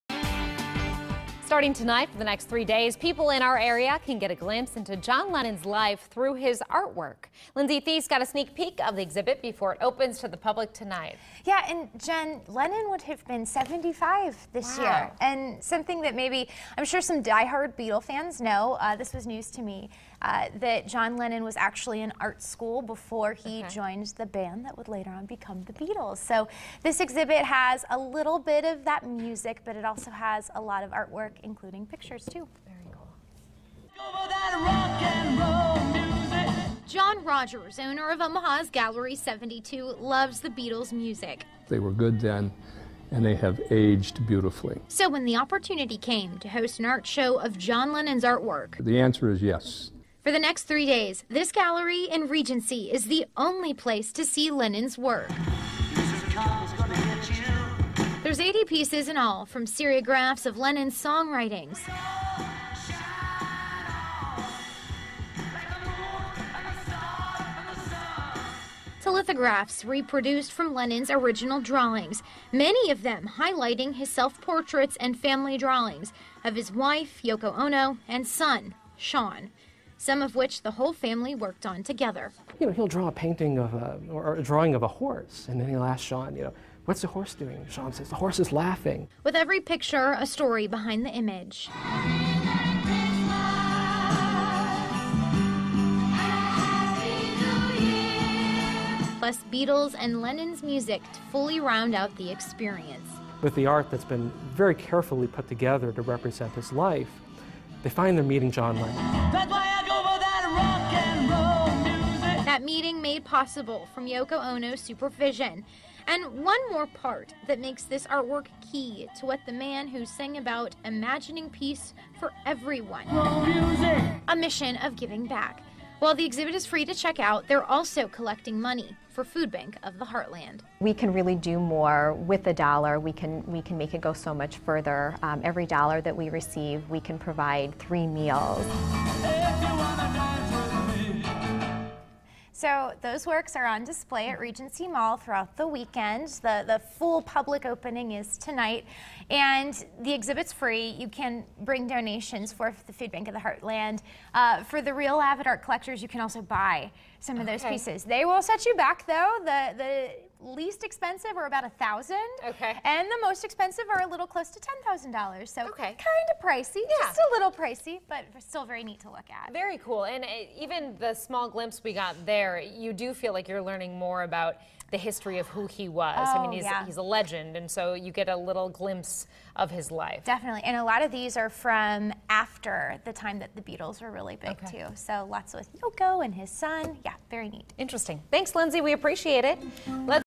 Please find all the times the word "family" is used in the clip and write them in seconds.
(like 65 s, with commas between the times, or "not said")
75 s, 80 s.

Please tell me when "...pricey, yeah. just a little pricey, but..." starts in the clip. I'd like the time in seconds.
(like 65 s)
166 s.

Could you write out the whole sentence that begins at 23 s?
joined the band that would later on become the Beatles.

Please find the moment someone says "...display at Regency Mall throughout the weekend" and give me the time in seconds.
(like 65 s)
143 s.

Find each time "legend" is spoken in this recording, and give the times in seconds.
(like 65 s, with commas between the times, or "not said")
177 s.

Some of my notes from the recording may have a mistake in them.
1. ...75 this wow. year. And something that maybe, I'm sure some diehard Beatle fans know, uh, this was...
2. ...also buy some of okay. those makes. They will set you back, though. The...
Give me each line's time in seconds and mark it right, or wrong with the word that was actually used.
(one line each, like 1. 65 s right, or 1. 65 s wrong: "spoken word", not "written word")
1. 13 s right
2. 156 s wrong: "pieces", not "makes".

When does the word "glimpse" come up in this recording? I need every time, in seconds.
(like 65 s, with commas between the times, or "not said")
4 s, 171 s, 178 s.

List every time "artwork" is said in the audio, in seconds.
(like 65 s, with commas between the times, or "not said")
6 s, 30 s, 48 s, 118 s.